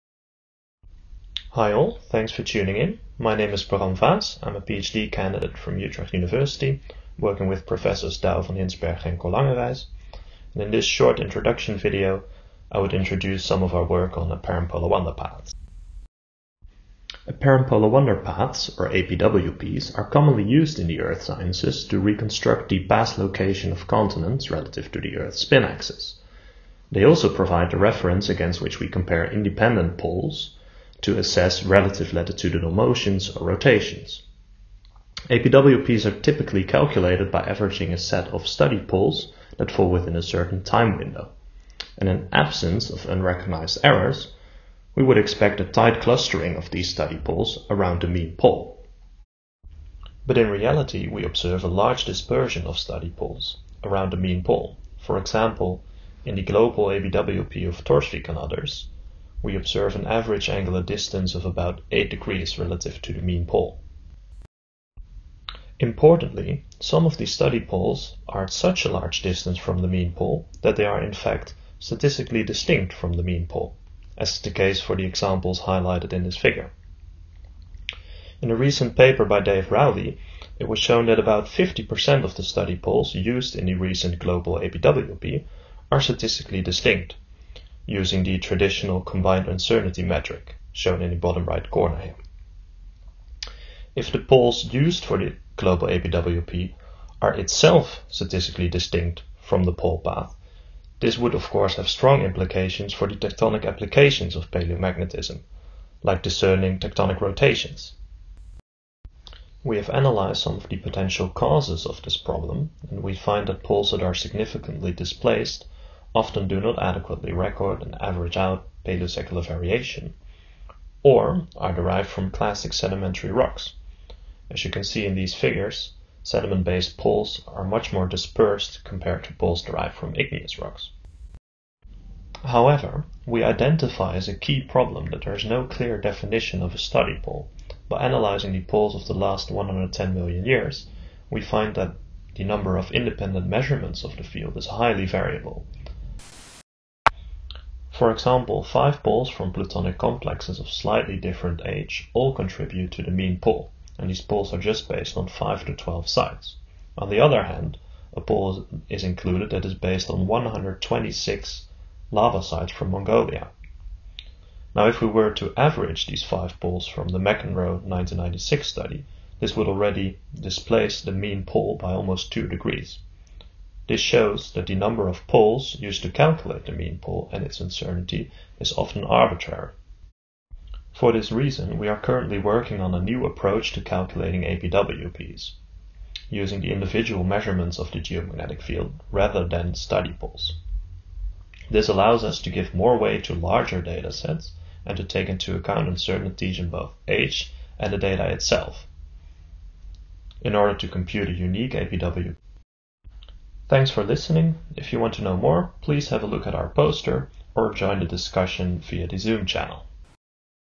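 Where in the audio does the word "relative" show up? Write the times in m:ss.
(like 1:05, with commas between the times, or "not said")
0:24, 0:31, 1:02.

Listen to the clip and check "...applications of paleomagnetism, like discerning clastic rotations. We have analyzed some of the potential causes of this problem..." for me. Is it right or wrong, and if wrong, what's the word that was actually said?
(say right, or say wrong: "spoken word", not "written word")
wrong: "tectonic", not "clastic".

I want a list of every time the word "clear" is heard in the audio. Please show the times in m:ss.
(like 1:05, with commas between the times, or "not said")
2:15.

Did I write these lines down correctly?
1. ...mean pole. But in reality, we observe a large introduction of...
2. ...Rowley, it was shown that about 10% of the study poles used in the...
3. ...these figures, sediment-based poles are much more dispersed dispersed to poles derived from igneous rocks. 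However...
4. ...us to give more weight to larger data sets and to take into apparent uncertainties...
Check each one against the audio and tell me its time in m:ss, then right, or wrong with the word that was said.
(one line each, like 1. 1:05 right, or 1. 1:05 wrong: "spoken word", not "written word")
1. 0:48 wrong: "dispersion", not "introduction"
2. 1:19 wrong: "50", not "10"
3. 2:05 wrong: "compared", not "dispersed"
4. 3:12 wrong: "account", not "apparent".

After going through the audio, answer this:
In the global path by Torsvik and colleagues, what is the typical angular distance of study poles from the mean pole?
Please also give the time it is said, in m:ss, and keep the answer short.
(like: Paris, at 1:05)
8 degrees, at 1:01.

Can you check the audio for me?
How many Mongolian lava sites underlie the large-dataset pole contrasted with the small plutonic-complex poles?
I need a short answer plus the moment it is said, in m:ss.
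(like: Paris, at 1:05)
126, at 2:40.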